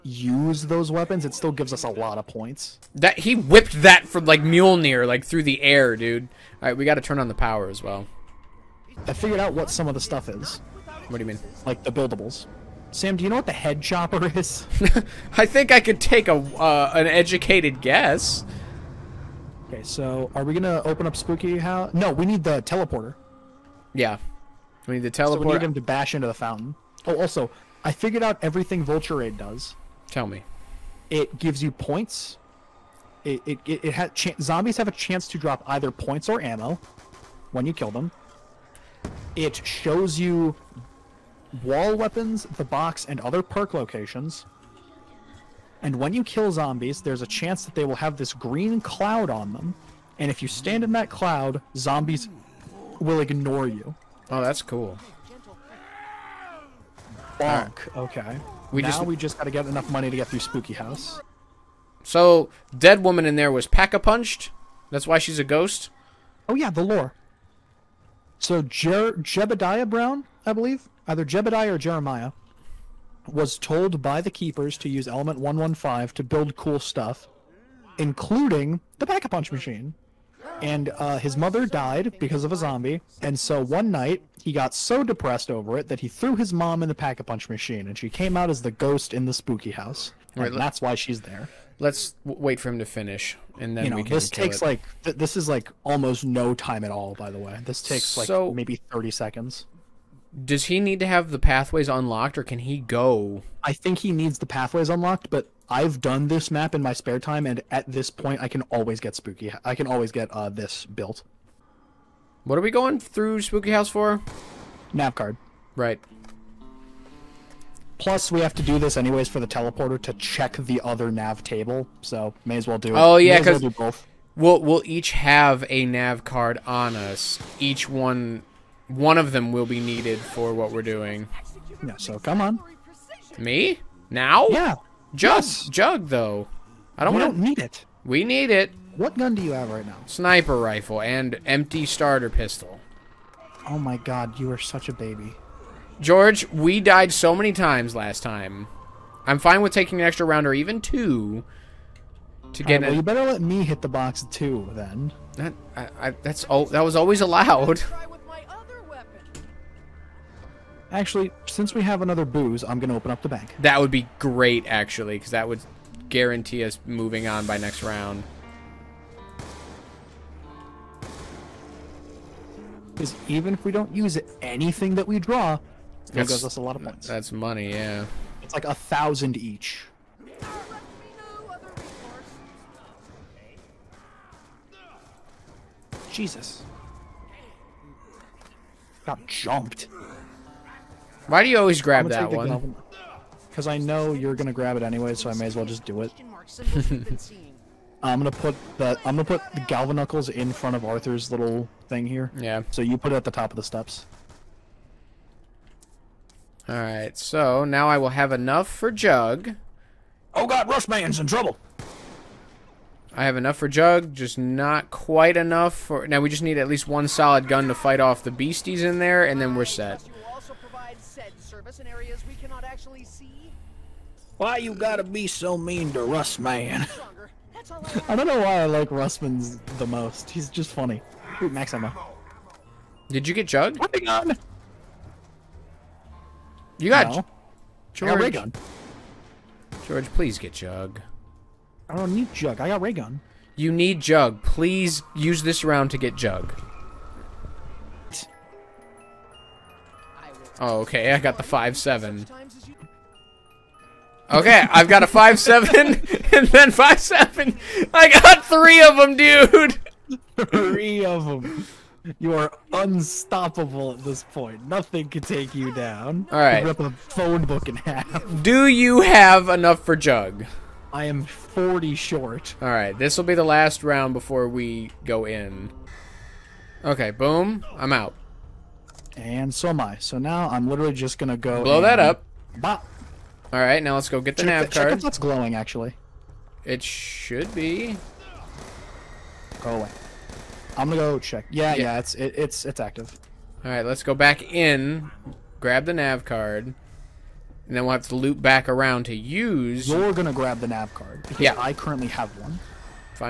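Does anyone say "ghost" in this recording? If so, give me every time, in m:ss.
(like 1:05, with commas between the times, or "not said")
1:05, 1:28.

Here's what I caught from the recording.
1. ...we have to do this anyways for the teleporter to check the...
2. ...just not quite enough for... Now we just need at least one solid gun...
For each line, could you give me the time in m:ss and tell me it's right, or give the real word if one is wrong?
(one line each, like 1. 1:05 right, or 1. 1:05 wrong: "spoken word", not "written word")
1. 1:58 right
2. 3:34 right.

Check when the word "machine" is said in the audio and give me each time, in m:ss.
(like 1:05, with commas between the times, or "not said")
1:19, 1:27.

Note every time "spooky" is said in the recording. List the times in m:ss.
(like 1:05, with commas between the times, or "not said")
0:21, 1:00, 1:29, 1:49, 1:53.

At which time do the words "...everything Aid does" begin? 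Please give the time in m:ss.
0:28.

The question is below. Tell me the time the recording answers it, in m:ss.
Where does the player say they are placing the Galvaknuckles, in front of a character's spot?
3:23.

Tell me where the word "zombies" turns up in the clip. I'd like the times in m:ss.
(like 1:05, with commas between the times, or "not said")
0:34, 0:46, 0:51, 1:22.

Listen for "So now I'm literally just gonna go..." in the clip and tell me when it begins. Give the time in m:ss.
4:39.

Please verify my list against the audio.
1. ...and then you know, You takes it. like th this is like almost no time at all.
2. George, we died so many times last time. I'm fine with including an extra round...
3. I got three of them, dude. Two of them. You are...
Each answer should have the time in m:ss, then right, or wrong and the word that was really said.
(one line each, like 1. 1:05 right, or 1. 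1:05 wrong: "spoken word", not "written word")
1. 1:33 wrong: "This", not "You"
2. 2:25 wrong: "taking", not "including"
3. 4:17 wrong: "Three", not "Two".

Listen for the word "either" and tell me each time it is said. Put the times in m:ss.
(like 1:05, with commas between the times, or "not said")
0:35, 1:11.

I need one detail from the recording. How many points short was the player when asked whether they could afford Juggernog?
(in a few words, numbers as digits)
40.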